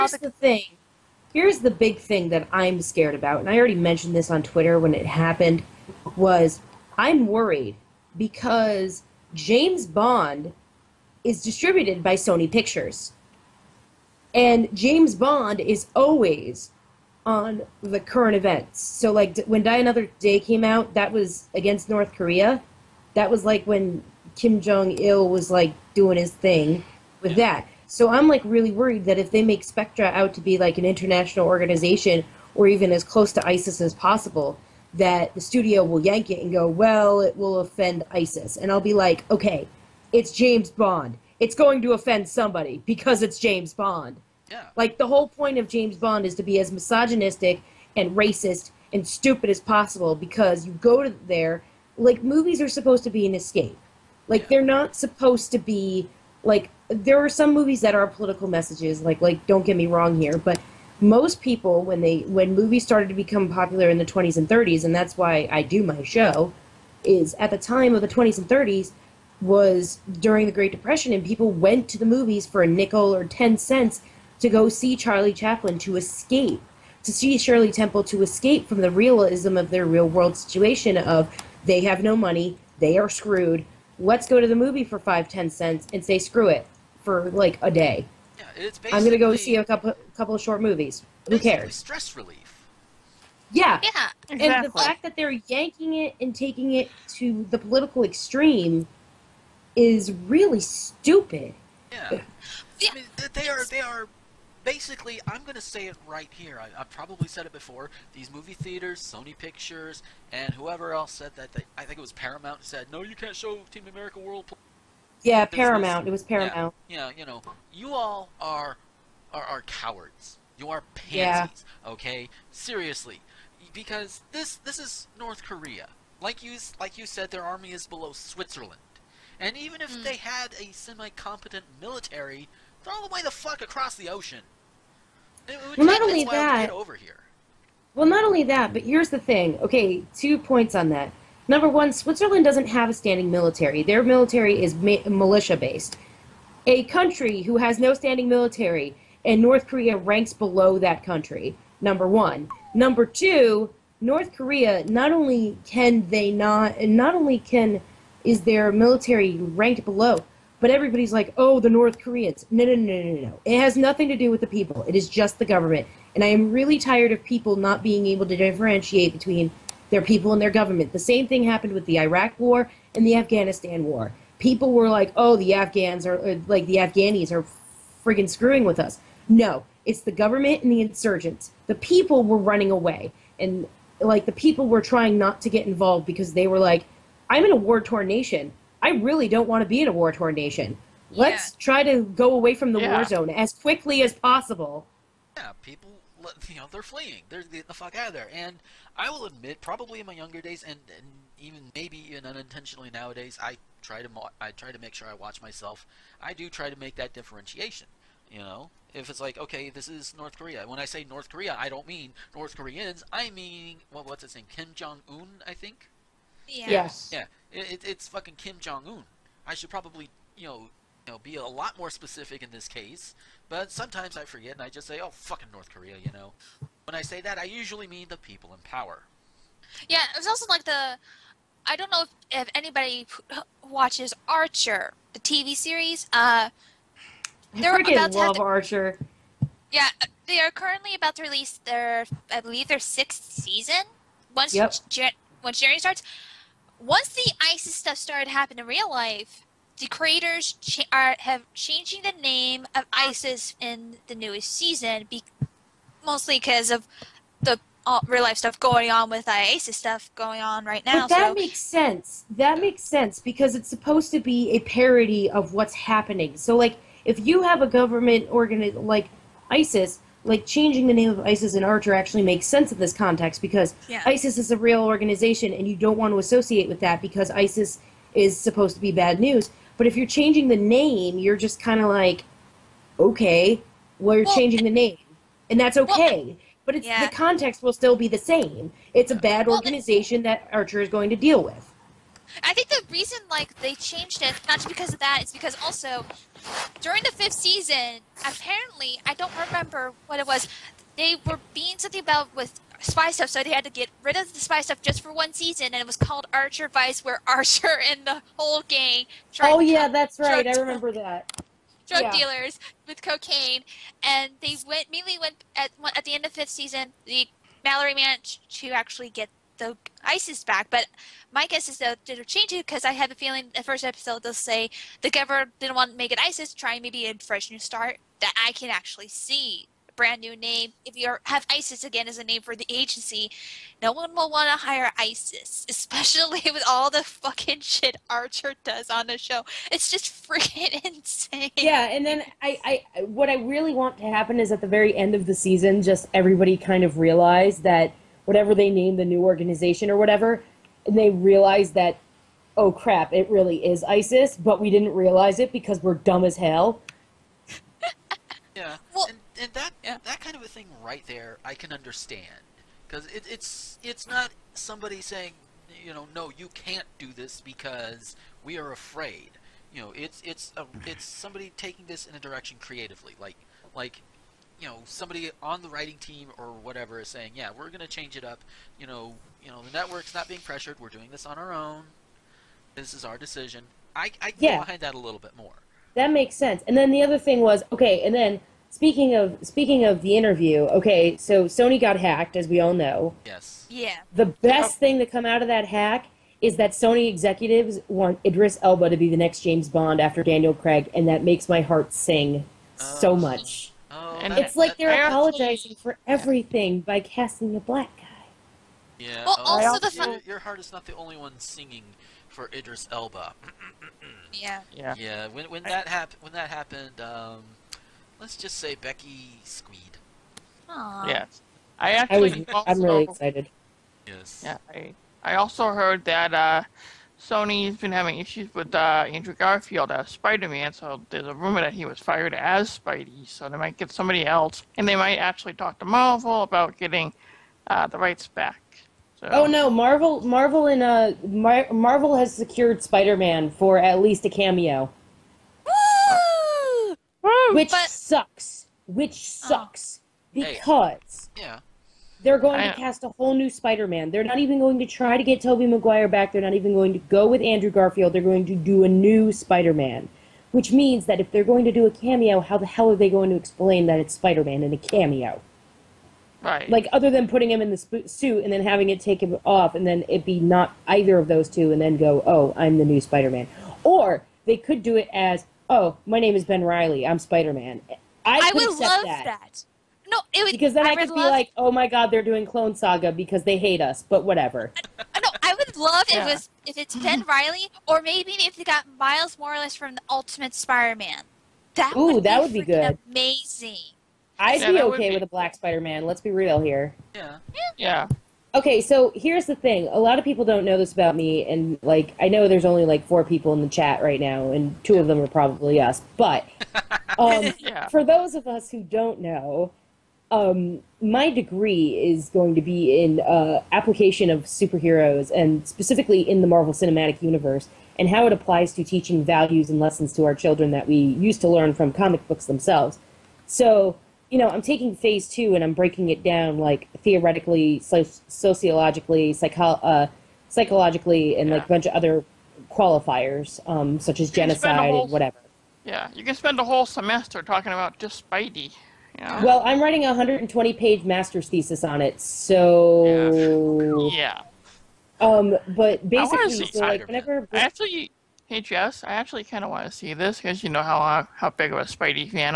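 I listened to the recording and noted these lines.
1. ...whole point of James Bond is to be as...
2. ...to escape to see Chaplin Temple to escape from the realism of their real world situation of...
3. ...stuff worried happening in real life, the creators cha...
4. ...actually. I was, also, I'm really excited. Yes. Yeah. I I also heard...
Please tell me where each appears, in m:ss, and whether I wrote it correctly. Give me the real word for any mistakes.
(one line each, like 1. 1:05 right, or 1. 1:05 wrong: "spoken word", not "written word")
1. 0:45 right
2. 1:15 wrong: "Shirley", not "Chaplin"
3. 4:07 wrong: "started", not "worried"
4. 7:01 right.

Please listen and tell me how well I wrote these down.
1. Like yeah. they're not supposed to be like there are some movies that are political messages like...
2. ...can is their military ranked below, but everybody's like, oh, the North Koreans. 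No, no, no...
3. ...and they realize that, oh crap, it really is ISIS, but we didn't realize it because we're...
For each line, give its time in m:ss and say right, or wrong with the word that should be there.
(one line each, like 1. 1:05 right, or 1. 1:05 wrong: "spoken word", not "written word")
1. 0:54 right
2. 2:37 right
3. 5:50 right.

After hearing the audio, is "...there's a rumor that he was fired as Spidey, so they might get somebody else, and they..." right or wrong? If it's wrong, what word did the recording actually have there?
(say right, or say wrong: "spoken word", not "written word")
right.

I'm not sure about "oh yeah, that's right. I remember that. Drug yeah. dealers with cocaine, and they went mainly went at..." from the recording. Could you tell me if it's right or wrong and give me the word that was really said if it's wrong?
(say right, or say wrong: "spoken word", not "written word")
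right.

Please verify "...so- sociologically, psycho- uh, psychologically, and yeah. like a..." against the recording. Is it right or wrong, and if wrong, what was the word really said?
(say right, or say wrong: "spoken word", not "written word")
right.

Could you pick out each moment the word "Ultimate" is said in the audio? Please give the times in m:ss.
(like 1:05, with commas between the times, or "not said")
8:10.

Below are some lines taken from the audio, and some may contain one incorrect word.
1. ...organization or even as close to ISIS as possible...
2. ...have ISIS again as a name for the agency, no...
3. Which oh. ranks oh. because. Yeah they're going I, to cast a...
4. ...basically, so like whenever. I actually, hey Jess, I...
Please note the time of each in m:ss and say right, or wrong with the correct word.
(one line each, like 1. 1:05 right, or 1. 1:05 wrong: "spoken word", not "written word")
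1. 0:31 right
2. 5:31 right
3. 7:28 wrong: "sucks", not "ranks"
4. 9:06 right.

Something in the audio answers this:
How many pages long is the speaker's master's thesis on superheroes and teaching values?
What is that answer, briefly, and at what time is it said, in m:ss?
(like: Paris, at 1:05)
120, at 9:00.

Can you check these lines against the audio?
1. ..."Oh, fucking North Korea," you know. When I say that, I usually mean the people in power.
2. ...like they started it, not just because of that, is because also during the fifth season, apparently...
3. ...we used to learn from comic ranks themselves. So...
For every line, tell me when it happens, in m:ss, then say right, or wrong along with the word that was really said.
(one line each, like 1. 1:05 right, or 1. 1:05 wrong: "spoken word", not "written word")
1. 3:45 right
2. 4:53 wrong: "changed", not "started"
3. 8:40 wrong: "books", not "ranks".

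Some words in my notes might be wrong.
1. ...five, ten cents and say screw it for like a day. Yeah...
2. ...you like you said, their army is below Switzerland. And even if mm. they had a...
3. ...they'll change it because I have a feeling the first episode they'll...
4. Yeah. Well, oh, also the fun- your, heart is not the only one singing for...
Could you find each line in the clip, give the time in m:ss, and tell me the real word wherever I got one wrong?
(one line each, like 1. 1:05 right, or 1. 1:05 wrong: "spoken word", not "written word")
1. 1:24 right
2. 2:06 right
3. 5:22 right
4. 6:48 right.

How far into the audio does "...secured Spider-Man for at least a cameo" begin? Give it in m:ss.
7:22.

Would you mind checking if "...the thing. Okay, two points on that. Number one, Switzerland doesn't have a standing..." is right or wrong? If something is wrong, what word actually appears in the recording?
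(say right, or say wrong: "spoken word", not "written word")
right.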